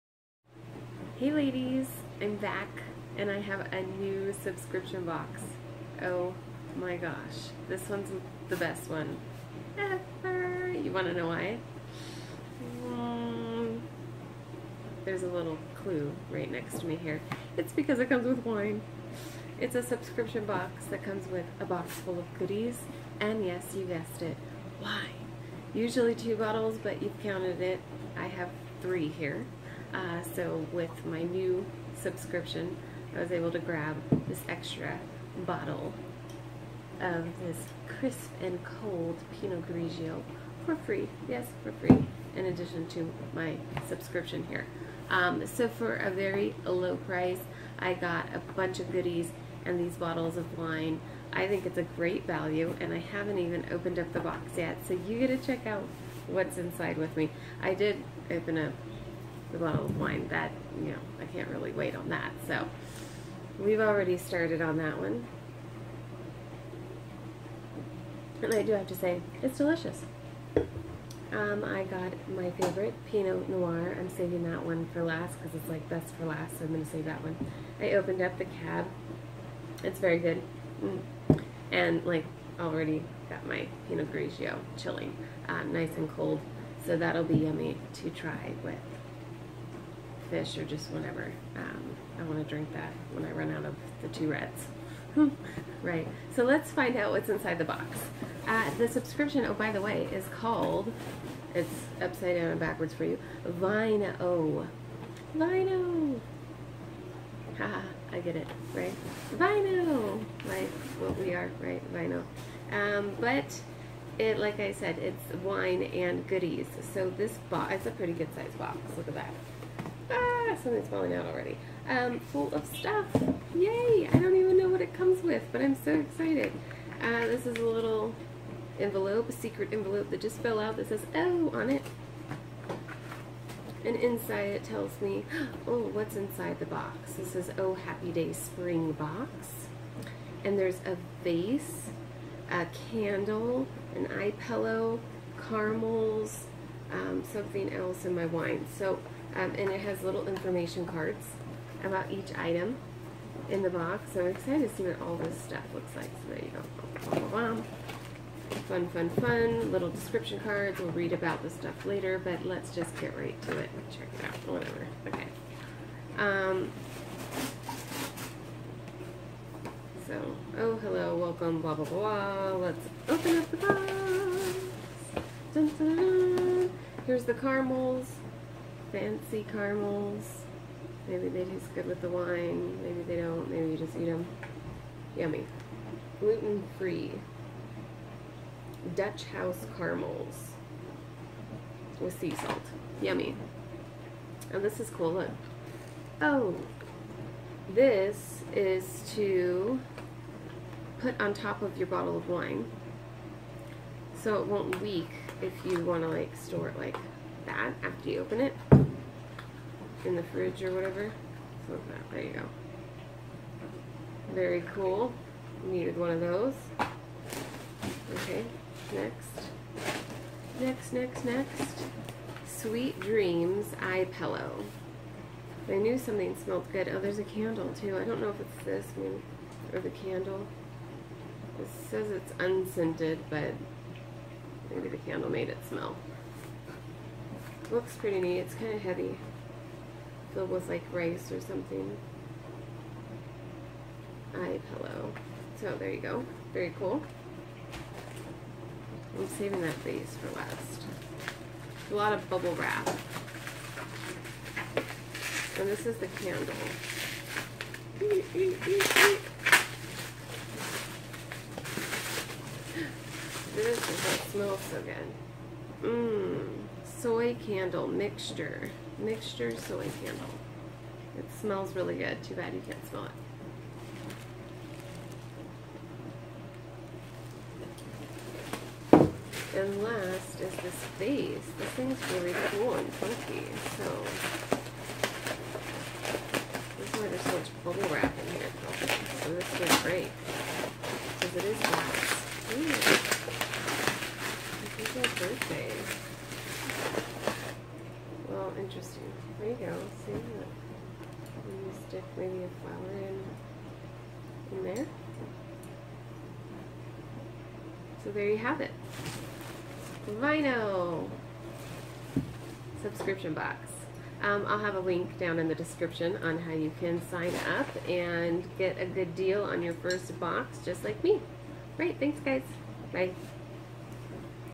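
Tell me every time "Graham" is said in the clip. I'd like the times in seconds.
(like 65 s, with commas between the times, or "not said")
not said.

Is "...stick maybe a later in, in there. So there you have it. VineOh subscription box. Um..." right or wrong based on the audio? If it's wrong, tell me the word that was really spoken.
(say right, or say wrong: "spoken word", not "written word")
wrong: "flower", not "later".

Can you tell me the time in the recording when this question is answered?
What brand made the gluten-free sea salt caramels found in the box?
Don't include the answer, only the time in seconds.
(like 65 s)
188 s.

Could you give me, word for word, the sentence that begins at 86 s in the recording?
So that'll be yummy to try with fish or just whenever.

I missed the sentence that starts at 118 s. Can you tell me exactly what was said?
Look at that something's falling out already.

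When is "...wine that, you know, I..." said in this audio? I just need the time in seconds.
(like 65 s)
59 s.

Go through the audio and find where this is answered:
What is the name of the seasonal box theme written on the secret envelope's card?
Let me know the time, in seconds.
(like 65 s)
137 s.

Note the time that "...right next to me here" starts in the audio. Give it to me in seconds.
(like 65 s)
16 s.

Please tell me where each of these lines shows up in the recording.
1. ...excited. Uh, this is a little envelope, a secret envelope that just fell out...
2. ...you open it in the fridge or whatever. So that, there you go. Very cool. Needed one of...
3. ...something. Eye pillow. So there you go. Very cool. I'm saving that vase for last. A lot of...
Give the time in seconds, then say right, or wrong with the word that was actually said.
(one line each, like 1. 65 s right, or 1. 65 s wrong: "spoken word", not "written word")
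1. 125 s right
2. 208 s right
3. 241 s right.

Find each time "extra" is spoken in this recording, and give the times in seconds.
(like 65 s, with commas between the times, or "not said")
34 s.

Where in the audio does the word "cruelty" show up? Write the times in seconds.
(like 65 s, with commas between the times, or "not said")
not said.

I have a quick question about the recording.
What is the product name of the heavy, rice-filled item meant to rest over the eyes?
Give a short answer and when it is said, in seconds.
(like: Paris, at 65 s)
Sweet Dreams Eye Pillow, at 222 s.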